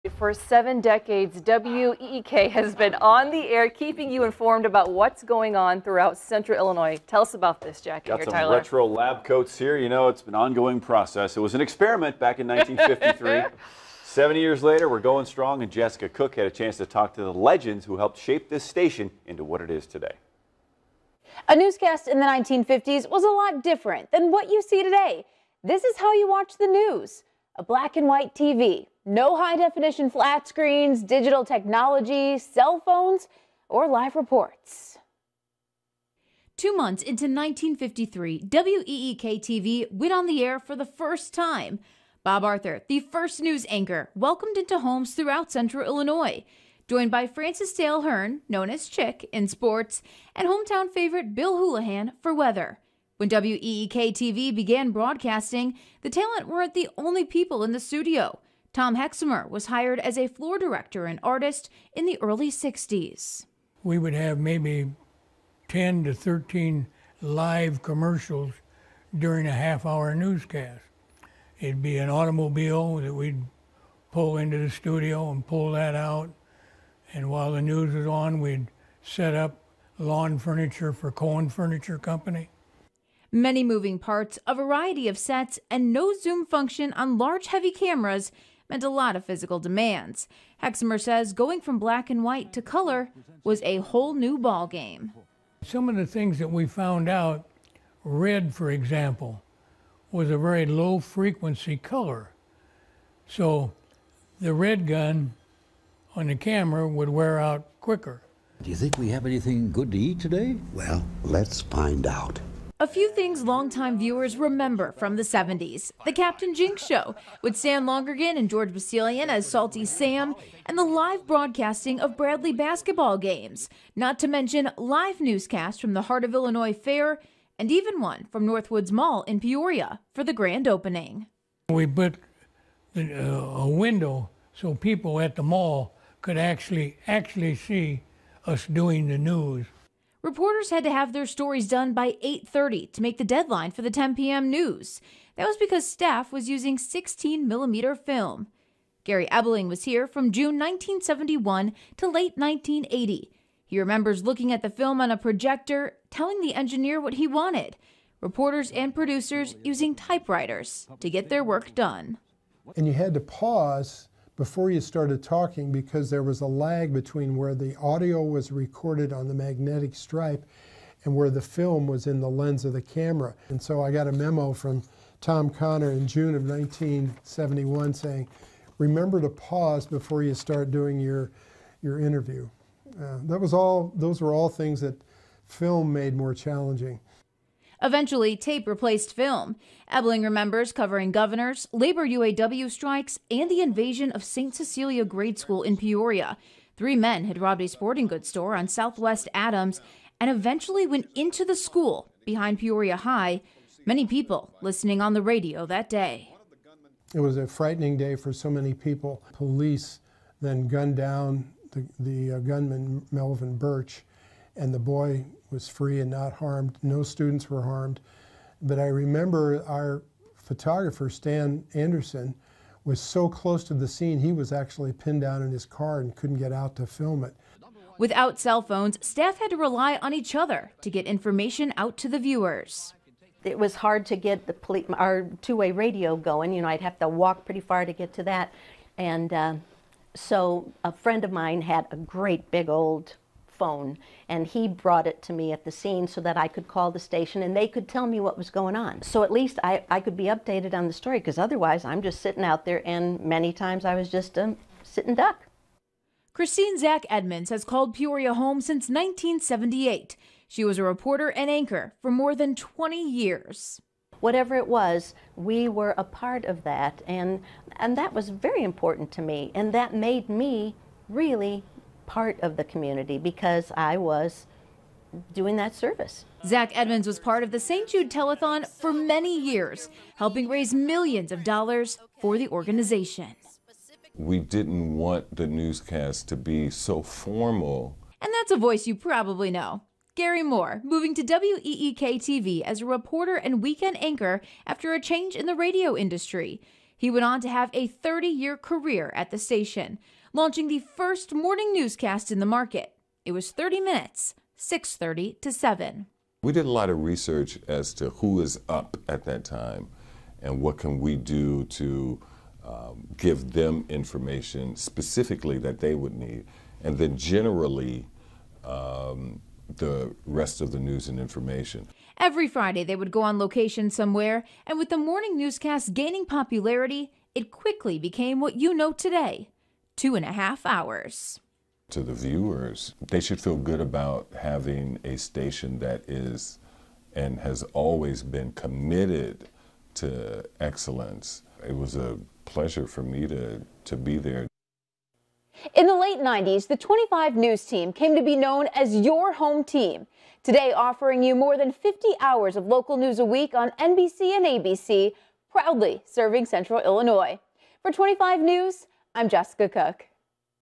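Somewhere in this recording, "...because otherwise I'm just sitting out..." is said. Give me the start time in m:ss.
4:11.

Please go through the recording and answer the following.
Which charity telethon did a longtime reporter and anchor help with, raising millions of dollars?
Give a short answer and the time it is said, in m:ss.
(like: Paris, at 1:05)
St. Jude Telethon, at 4:37.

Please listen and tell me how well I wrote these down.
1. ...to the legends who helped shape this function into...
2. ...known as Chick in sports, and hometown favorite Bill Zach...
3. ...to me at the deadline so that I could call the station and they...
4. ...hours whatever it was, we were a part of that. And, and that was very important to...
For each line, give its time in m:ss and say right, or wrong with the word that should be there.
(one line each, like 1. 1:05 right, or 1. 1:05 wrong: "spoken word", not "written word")
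1. 0:17 wrong: "station", not "function"
2. 0:48 wrong: "Houlihan", not "Zach"
3. 4:05 wrong: "scene", not "deadline"
4. 4:23 wrong: "years", not "hours".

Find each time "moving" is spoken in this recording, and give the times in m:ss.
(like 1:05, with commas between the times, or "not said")
1:23, 4:50.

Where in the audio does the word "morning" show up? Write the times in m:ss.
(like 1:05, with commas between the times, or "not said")
5:01, 5:24.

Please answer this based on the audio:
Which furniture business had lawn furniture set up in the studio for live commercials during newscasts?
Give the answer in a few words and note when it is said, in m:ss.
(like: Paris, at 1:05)
Cohen Furniture Company, at 1:21.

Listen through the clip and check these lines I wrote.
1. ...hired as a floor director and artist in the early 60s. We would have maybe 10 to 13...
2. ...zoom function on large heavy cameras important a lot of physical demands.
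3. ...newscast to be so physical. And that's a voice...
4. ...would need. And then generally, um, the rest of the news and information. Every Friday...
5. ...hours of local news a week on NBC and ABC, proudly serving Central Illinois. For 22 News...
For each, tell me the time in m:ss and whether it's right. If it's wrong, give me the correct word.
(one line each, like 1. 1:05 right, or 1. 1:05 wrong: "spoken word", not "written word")
1. 0:59 right
2. 1:26 wrong: "meant", not "important"
3. 4:45 wrong: "formal", not "physical"
4. 5:15 right
5. 5:52 wrong: "25", not "22".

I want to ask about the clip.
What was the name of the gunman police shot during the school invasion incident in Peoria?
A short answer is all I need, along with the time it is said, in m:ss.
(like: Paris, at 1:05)
Melvin Birch, at 3:33.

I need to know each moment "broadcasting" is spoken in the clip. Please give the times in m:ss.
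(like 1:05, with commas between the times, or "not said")
0:54, 2:01.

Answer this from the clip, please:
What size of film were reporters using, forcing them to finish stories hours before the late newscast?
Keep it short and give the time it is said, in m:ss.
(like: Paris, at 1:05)
16 millimeter, at 2:26.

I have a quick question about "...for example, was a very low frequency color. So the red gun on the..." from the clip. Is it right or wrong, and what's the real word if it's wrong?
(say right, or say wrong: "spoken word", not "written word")
right.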